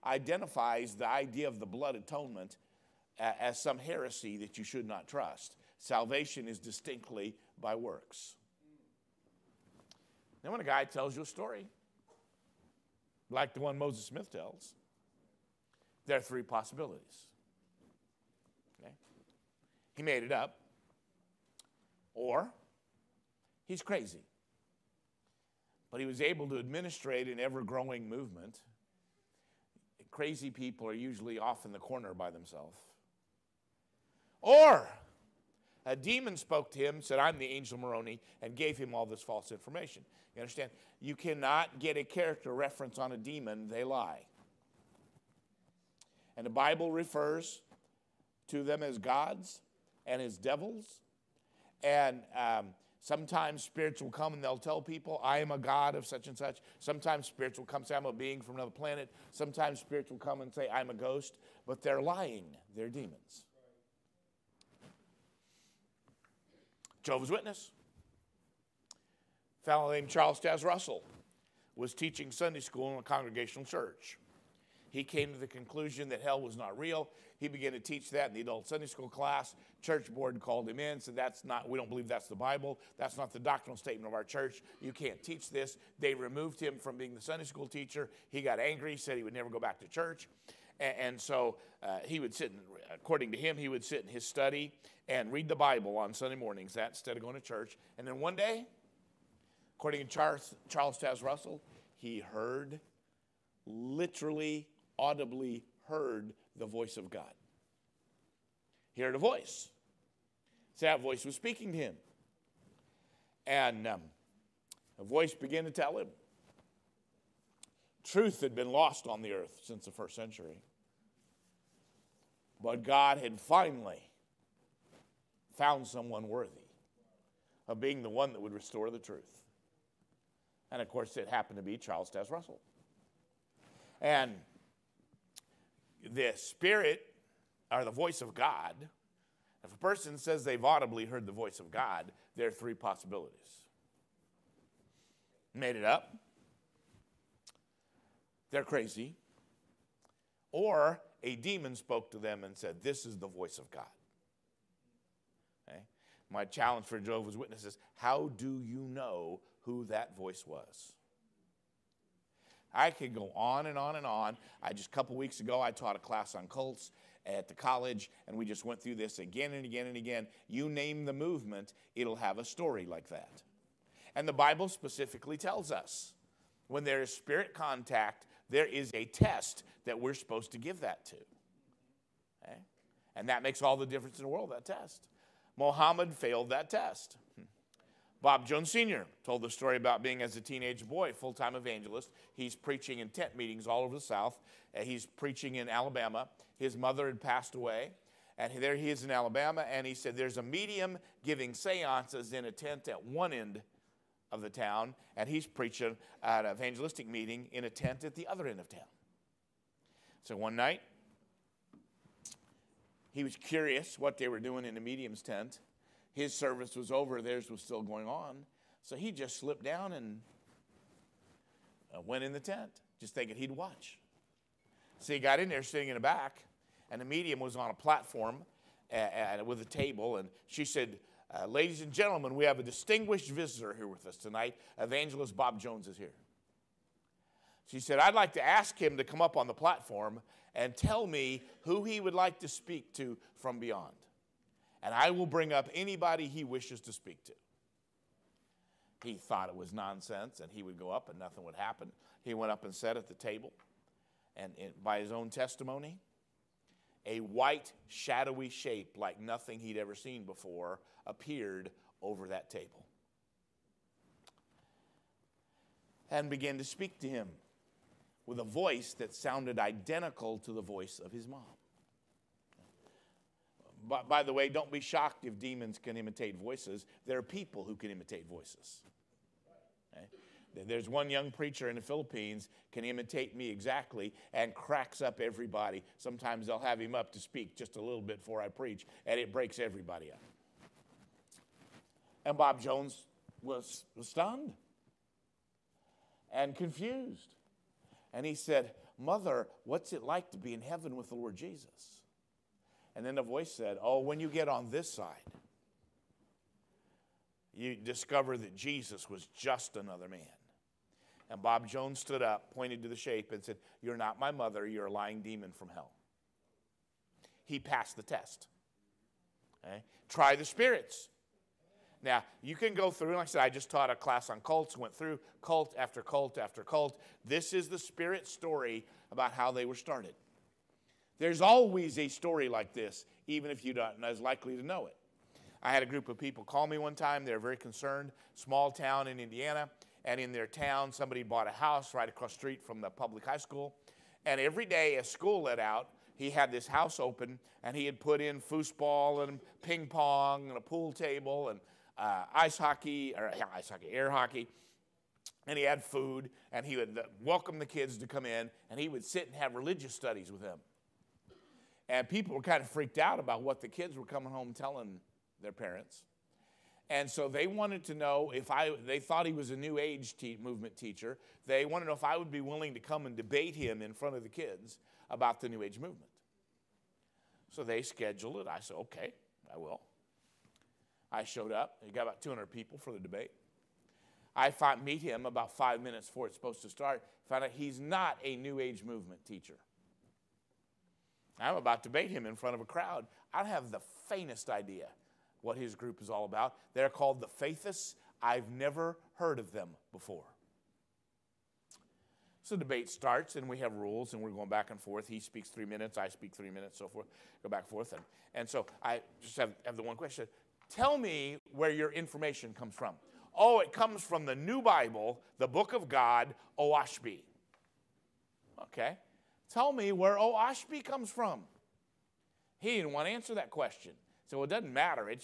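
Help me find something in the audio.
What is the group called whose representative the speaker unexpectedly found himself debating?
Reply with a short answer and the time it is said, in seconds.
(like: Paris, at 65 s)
the Faithists, at 397 s.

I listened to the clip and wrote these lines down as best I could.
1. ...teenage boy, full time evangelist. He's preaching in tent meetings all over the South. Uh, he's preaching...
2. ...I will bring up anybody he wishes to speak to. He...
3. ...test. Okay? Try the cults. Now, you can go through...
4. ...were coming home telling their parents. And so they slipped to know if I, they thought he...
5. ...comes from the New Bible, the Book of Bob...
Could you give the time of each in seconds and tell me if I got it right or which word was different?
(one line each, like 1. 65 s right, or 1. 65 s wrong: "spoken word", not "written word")
1. 190 s right
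2. 244 s right
3. 318 s wrong: "spirits", not "cults"
4. 363 s wrong: "wanted", not "slipped"
5. 413 s wrong: "God", not "Bob".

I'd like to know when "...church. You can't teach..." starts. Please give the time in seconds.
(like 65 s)
84 s.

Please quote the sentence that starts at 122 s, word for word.
But God had finally found someone worthy of being the one that would restore the truth.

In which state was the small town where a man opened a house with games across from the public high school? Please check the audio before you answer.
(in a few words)
Indiana.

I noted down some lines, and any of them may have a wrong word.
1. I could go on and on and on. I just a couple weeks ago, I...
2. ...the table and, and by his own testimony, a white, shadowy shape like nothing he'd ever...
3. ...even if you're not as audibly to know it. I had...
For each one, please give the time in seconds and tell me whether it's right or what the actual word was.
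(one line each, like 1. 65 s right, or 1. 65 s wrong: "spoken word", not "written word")
1. 162 s right
2. 253 s right
3. 333 s wrong: "likely", not "audibly".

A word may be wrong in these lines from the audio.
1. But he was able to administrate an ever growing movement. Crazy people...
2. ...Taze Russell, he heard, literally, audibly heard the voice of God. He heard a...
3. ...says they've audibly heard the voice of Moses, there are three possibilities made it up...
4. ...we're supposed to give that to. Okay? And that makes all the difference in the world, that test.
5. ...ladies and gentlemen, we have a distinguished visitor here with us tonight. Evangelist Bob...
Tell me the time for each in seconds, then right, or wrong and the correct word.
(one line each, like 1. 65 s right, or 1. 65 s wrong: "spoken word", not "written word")
1. 25 s right
2. 100 s right
3. 140 s wrong: "God", not "Moses"
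4. 179 s right
5. 231 s right.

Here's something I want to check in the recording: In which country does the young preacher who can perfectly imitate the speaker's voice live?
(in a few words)
Philippines.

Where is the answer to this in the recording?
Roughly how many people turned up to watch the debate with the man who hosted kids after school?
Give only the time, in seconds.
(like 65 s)
382 s.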